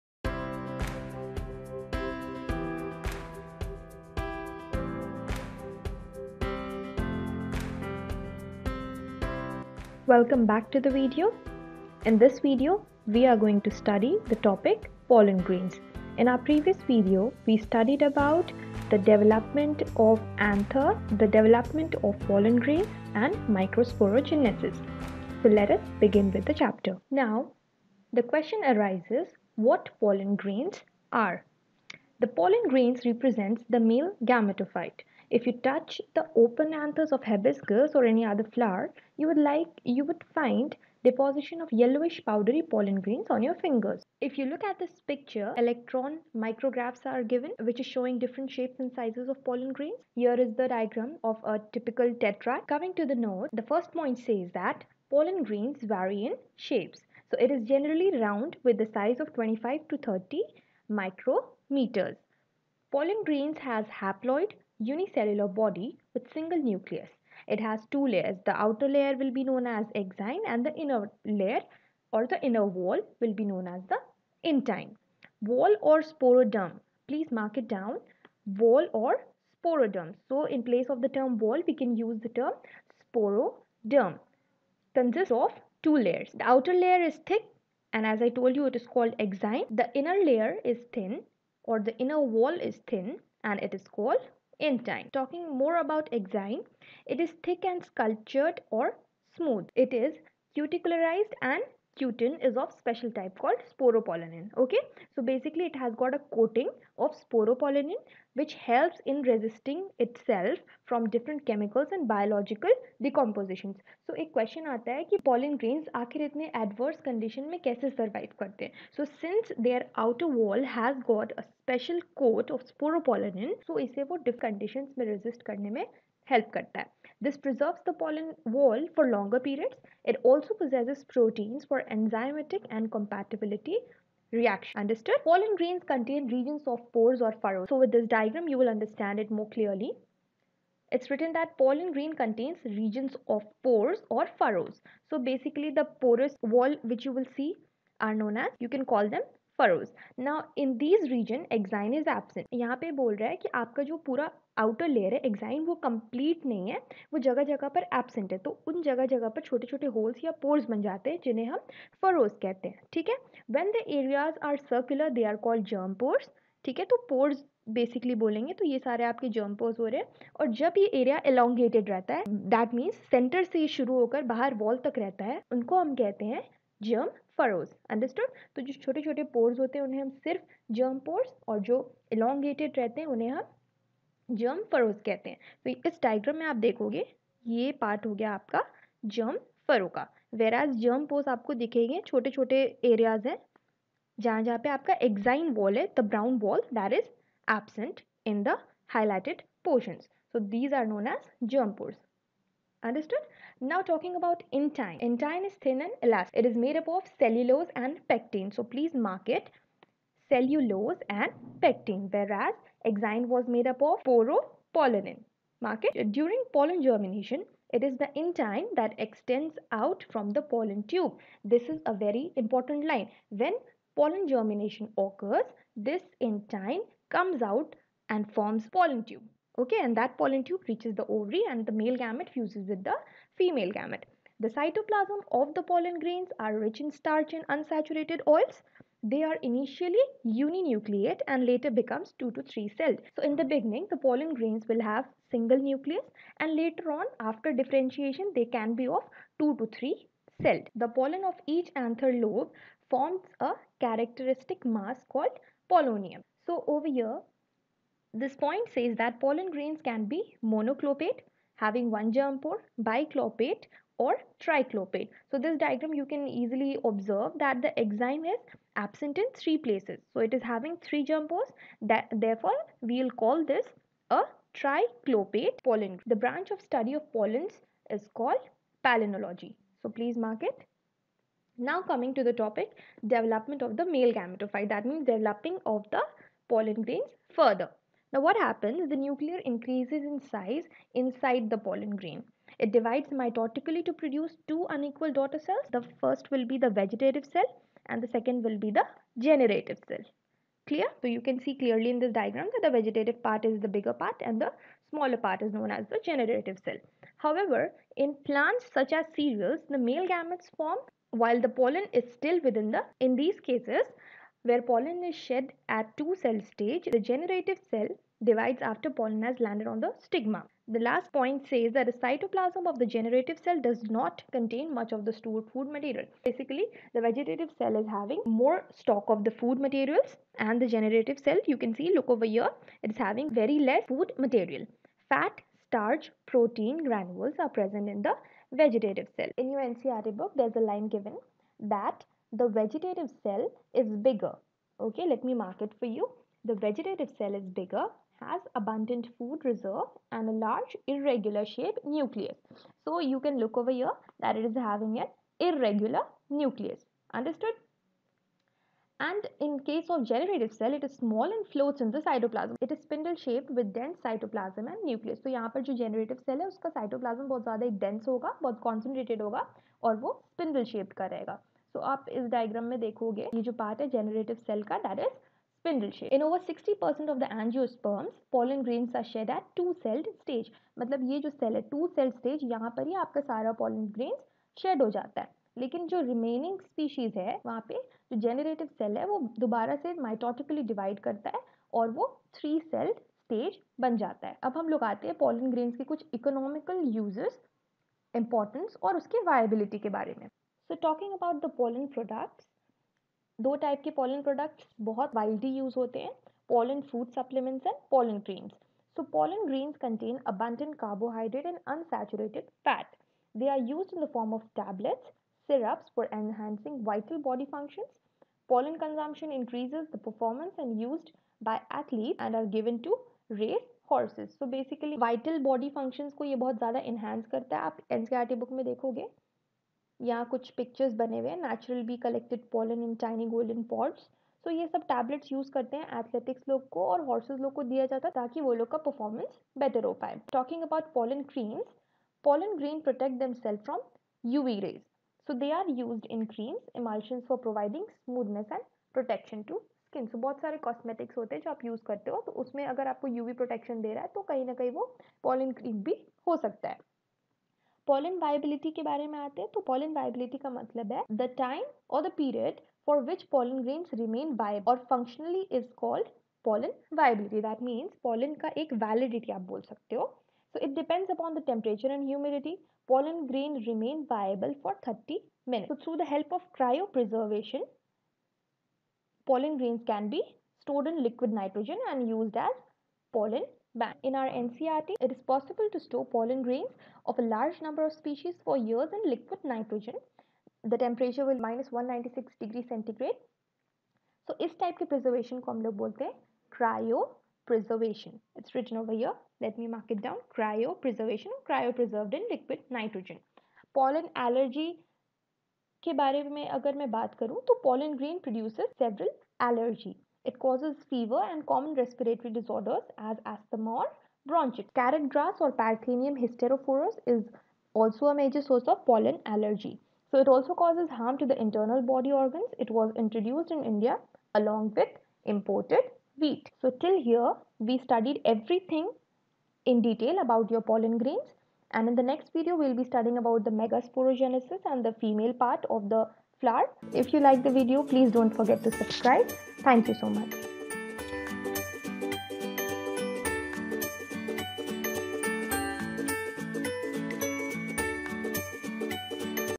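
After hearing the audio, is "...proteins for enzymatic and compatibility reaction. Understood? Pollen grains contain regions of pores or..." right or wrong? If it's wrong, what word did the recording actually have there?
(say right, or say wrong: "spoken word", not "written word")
right.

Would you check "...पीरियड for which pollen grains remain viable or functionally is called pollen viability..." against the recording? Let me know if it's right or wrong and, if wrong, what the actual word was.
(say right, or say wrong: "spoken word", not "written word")
right.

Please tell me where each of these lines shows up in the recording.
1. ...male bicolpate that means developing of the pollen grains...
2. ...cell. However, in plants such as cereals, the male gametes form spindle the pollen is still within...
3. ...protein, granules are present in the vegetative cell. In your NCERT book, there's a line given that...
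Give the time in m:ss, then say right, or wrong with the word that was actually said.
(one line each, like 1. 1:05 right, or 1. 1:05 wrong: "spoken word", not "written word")
1. 4:43 wrong: "gametophyte", not "bicolpate"
2. 5:06 wrong: "while", not "spindle"
3. 5:36 right.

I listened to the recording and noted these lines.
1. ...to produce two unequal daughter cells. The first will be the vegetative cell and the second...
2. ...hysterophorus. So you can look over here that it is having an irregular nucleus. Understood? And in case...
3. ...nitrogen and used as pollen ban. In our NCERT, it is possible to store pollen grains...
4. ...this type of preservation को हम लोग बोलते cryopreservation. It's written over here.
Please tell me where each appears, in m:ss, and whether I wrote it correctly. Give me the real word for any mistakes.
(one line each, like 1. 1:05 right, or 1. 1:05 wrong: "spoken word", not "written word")
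1. 4:53 right
2. 5:51 wrong: "nucleus", not "hysterophorus"
3. 8:01 right
4. 8:14 right.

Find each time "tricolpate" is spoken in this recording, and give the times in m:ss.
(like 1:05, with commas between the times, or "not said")
4:24, 4:34.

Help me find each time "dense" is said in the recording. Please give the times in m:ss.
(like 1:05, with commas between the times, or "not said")
6:03, 6:07.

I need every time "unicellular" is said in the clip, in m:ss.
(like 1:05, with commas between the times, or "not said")
1:04.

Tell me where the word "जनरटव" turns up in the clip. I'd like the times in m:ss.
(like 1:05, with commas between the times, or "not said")
6:13, 6:28.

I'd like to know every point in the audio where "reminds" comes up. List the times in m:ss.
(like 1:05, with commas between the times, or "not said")
not said.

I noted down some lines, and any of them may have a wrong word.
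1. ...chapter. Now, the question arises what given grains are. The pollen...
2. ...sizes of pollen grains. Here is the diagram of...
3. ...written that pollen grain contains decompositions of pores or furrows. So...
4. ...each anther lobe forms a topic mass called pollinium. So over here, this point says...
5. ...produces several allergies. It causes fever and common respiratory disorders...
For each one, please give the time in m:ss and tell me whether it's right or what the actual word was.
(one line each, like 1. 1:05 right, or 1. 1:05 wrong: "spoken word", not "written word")
1. 0:26 wrong: "pollen", not "given"
2. 0:48 right
3. 2:21 wrong: "regions", not "decompositions"
4. 4:11 wrong: "characteristic", not "topic"
5. 8:28 right.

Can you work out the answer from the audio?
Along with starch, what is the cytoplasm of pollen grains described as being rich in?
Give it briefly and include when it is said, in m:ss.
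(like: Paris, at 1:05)
Unsaturated oils, at 3:57.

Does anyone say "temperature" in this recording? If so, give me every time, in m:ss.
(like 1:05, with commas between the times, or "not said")
7:51, 8:10.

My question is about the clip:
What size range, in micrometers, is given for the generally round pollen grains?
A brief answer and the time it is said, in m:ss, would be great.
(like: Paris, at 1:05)
25 to 30 micrometers, at 0:59.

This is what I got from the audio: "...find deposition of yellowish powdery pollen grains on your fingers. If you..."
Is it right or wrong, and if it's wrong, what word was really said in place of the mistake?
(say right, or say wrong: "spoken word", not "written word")
right.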